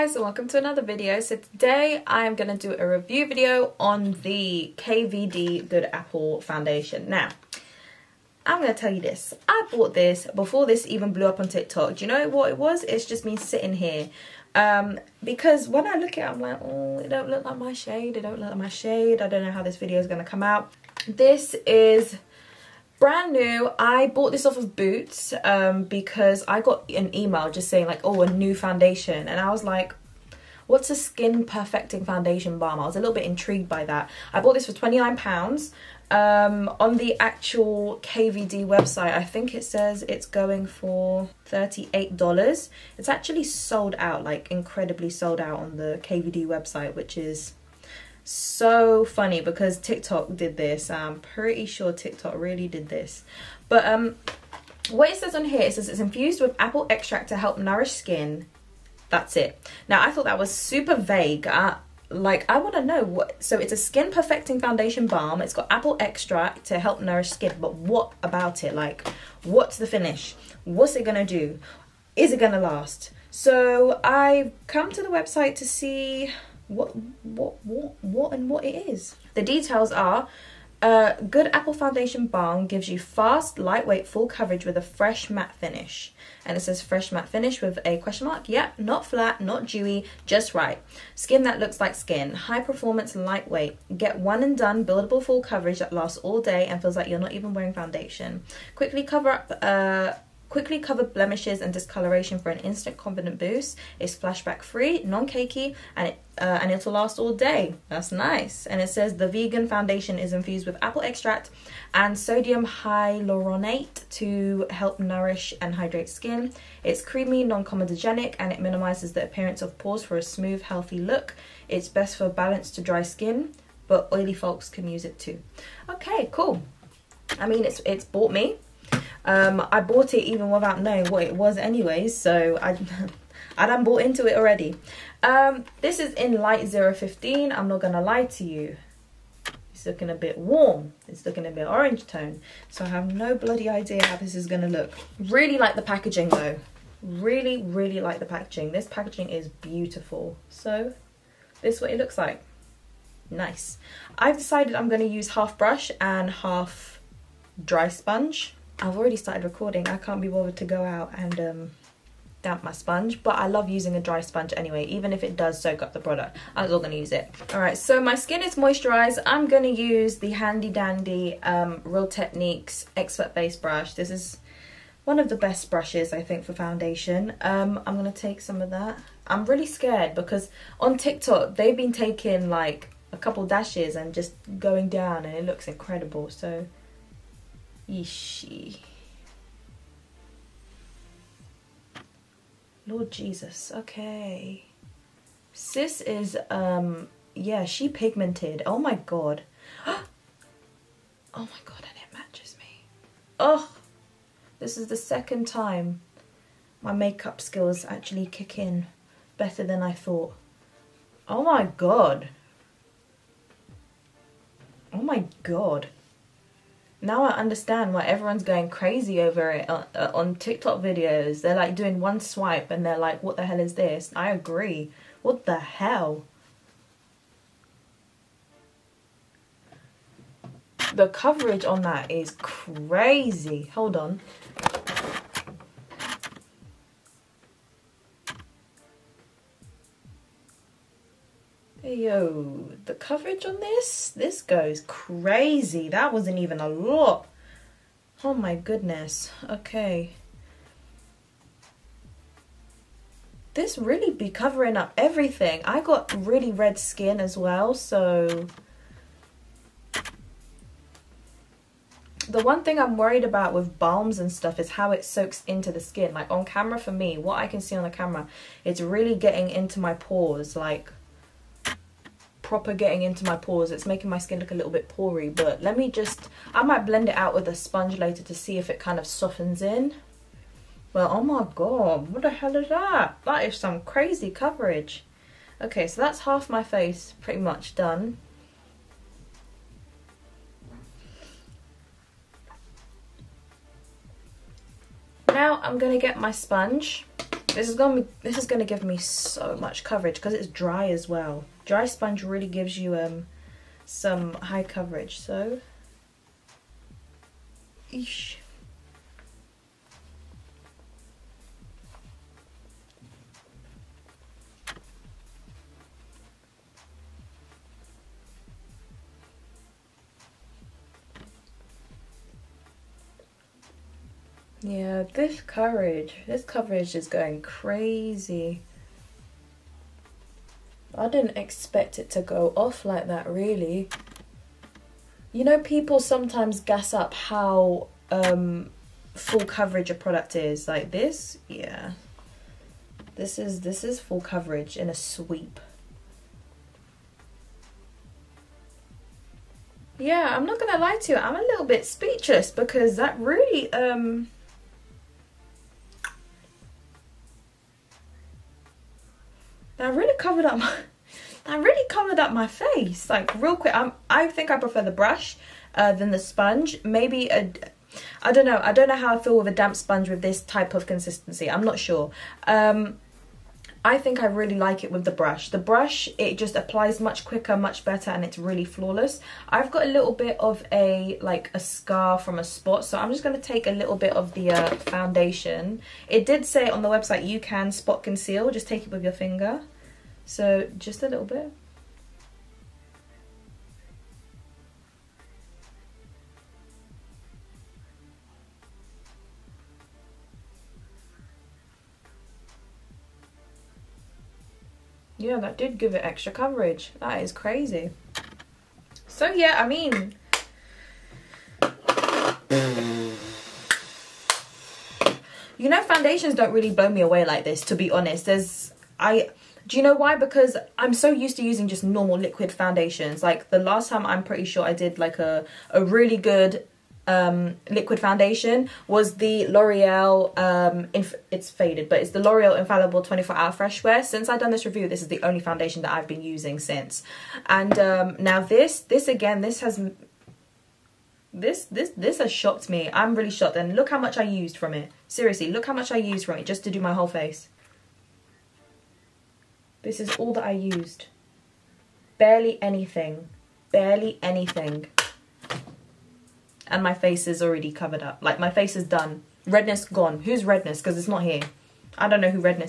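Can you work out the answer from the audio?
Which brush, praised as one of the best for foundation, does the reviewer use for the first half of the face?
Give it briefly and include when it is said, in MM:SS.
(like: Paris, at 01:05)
Real Techniques Expert Base Brush, at 02:51.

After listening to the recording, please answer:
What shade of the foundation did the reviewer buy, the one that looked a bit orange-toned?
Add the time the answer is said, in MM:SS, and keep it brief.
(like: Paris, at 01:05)
Light 015, at 02:16.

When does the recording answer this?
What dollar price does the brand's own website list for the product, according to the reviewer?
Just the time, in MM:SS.
00:41.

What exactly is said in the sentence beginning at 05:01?
Dry sponge really gives you um some high coverage.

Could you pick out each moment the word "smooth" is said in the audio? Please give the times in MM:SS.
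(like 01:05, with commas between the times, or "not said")
02:00.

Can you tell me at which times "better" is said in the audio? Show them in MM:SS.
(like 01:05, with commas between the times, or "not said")
03:29, 06:17.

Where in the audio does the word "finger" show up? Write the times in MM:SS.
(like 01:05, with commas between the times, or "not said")
06:29.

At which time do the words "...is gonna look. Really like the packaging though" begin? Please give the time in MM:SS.
02:24.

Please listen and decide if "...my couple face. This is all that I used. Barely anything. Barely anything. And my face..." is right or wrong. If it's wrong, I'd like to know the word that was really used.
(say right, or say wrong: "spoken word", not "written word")
wrong: "whole", not "couple".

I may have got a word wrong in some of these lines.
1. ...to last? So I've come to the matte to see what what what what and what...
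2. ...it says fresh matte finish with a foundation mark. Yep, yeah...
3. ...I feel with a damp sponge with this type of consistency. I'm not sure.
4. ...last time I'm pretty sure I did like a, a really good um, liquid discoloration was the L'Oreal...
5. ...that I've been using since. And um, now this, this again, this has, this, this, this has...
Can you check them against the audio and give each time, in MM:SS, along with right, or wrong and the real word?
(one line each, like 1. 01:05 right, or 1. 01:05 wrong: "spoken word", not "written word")
1. 01:12 wrong: "website", not "matte"
2. 01:26 wrong: "question", not "foundation"
3. 06:09 right
4. 07:03 wrong: "foundation", not "discoloration"
5. 07:15 right.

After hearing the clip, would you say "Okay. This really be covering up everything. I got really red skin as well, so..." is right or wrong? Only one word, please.
right.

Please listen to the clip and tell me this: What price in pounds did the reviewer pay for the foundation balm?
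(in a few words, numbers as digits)
£29.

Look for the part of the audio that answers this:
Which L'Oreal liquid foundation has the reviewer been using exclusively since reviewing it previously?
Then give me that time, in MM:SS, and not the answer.
07:12.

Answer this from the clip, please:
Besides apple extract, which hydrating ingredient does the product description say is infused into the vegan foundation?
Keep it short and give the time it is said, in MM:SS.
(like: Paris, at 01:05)
sodium hyaluronate, at 01:52.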